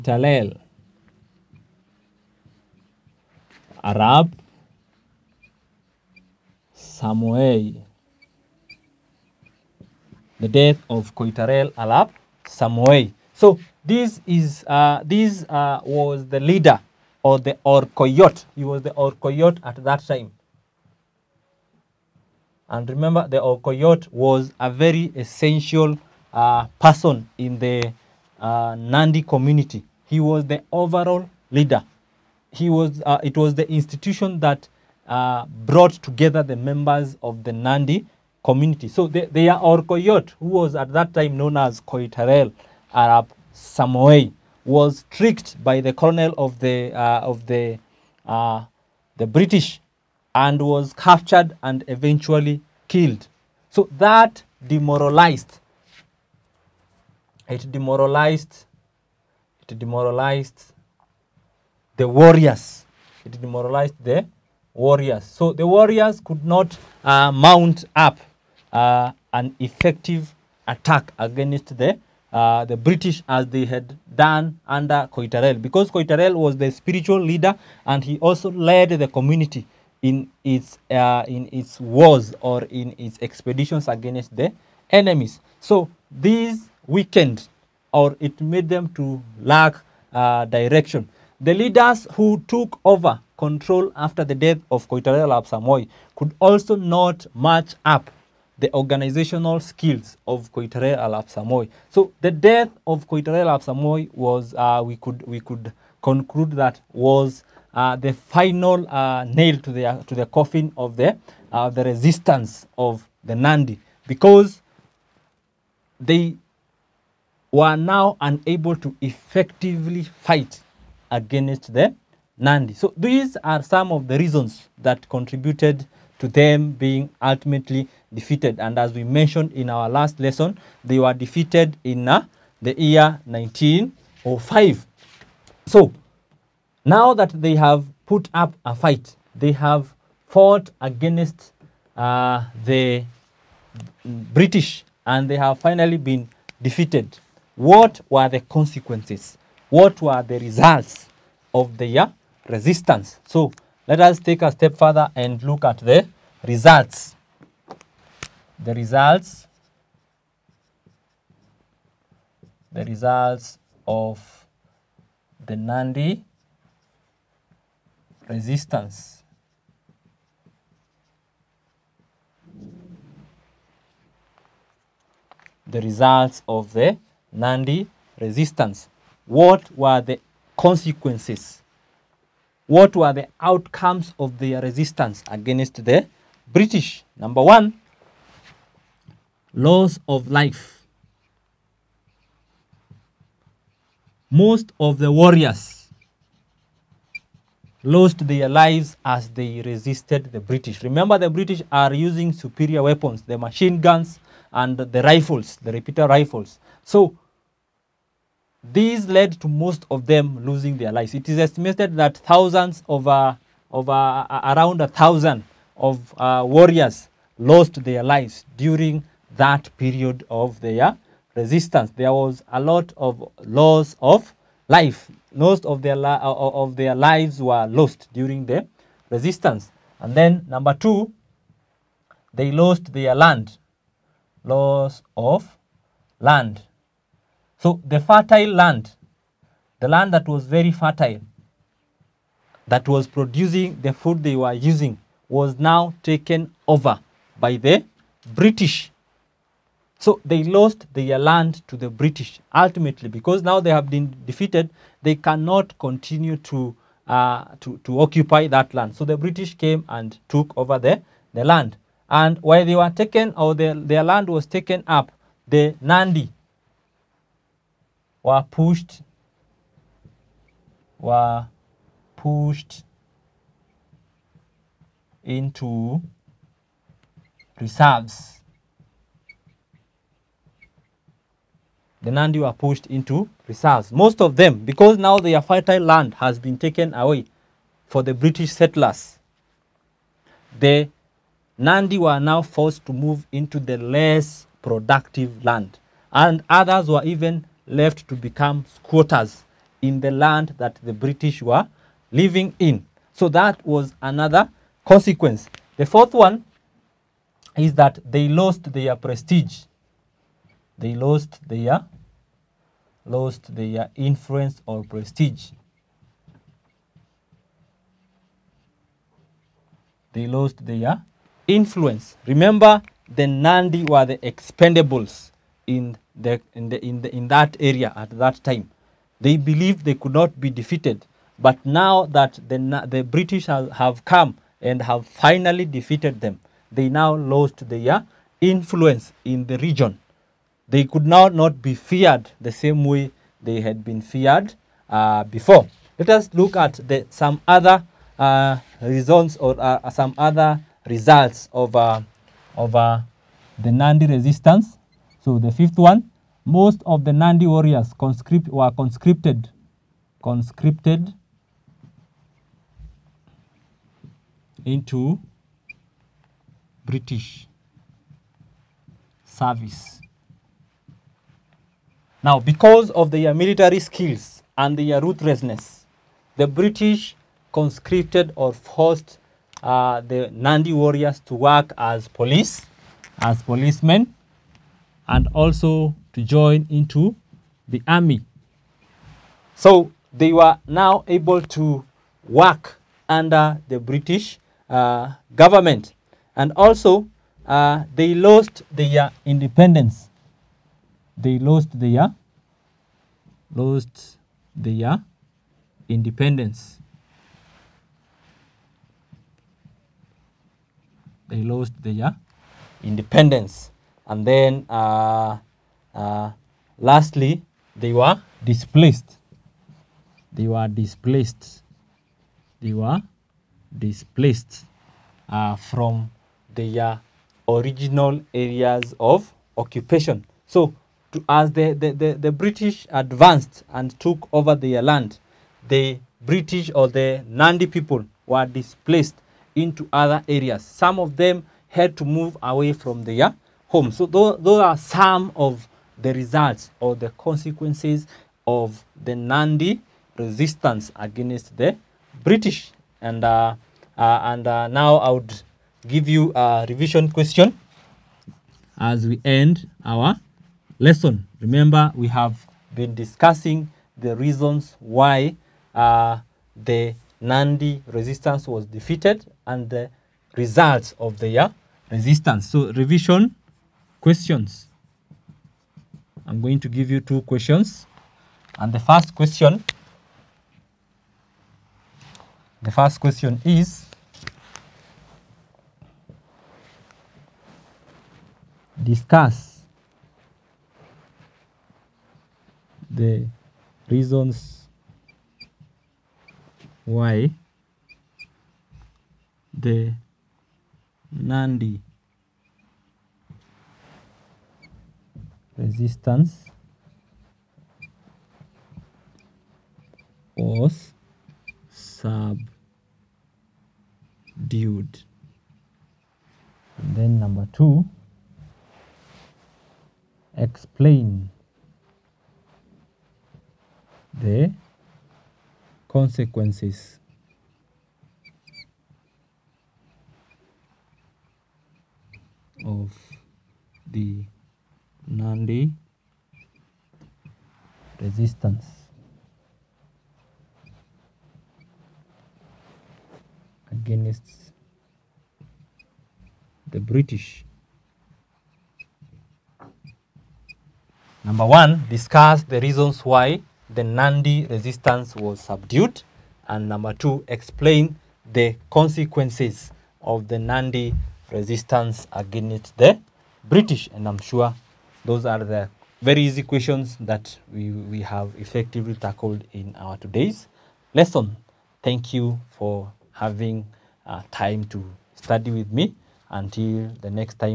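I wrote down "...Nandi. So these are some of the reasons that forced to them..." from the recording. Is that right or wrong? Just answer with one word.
wrong.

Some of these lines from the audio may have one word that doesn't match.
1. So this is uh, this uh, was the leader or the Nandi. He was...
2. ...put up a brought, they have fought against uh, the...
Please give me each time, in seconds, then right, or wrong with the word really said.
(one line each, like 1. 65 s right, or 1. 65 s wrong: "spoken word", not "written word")
1. 13 s wrong: "Orkoyot", not "Nandi"
2. 138 s wrong: "fight", not "brought".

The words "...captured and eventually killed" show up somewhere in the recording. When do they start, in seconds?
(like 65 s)
50 s.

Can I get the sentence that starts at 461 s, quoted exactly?
Remember, we have been discussing the reasons why uh, the Nandi resistance was defeated and the results of their resistance.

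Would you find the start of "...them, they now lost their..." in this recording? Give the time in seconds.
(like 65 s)
336 s.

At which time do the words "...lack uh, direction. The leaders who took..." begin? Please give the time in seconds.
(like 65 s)
89 s.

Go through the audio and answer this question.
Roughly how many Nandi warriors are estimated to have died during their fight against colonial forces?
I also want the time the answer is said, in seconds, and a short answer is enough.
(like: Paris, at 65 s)
around 1000, at 214 s.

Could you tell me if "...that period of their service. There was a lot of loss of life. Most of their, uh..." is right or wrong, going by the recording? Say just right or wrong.
wrong.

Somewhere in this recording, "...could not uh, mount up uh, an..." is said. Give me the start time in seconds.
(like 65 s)
66 s.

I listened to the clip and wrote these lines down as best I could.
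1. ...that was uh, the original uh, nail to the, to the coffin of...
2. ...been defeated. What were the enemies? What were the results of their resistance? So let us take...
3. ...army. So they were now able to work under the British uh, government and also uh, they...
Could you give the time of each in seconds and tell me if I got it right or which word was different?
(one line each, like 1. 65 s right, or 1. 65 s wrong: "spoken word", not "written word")
1. 106 s wrong: "final", not "original"
2. 145 s wrong: "consequences", not "enemies"
3. 387 s right.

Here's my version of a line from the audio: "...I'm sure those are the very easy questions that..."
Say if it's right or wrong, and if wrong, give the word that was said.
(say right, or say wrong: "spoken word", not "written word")
right.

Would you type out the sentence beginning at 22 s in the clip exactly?
And remember, the Orkoyot was a very essential uh, person in the uh, Nandi community.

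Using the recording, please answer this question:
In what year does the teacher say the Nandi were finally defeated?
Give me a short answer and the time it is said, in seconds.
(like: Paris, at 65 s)
1905, at 133 s.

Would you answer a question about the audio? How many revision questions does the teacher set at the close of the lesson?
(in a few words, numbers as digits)
2.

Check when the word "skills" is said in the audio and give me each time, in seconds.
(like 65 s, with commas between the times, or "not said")
99 s, 373 s.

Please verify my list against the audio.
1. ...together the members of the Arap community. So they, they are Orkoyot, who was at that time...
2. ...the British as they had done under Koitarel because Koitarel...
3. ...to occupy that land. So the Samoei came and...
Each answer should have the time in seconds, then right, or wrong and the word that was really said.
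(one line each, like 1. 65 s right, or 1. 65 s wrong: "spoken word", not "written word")
1. 36 s wrong: "Nandi", not "Arap"
2. 72 s right
3. 257 s wrong: "British", not "Samoei".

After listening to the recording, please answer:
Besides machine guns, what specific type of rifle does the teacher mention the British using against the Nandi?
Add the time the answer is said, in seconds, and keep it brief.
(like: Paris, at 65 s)
Repeater rifles, at 205 s.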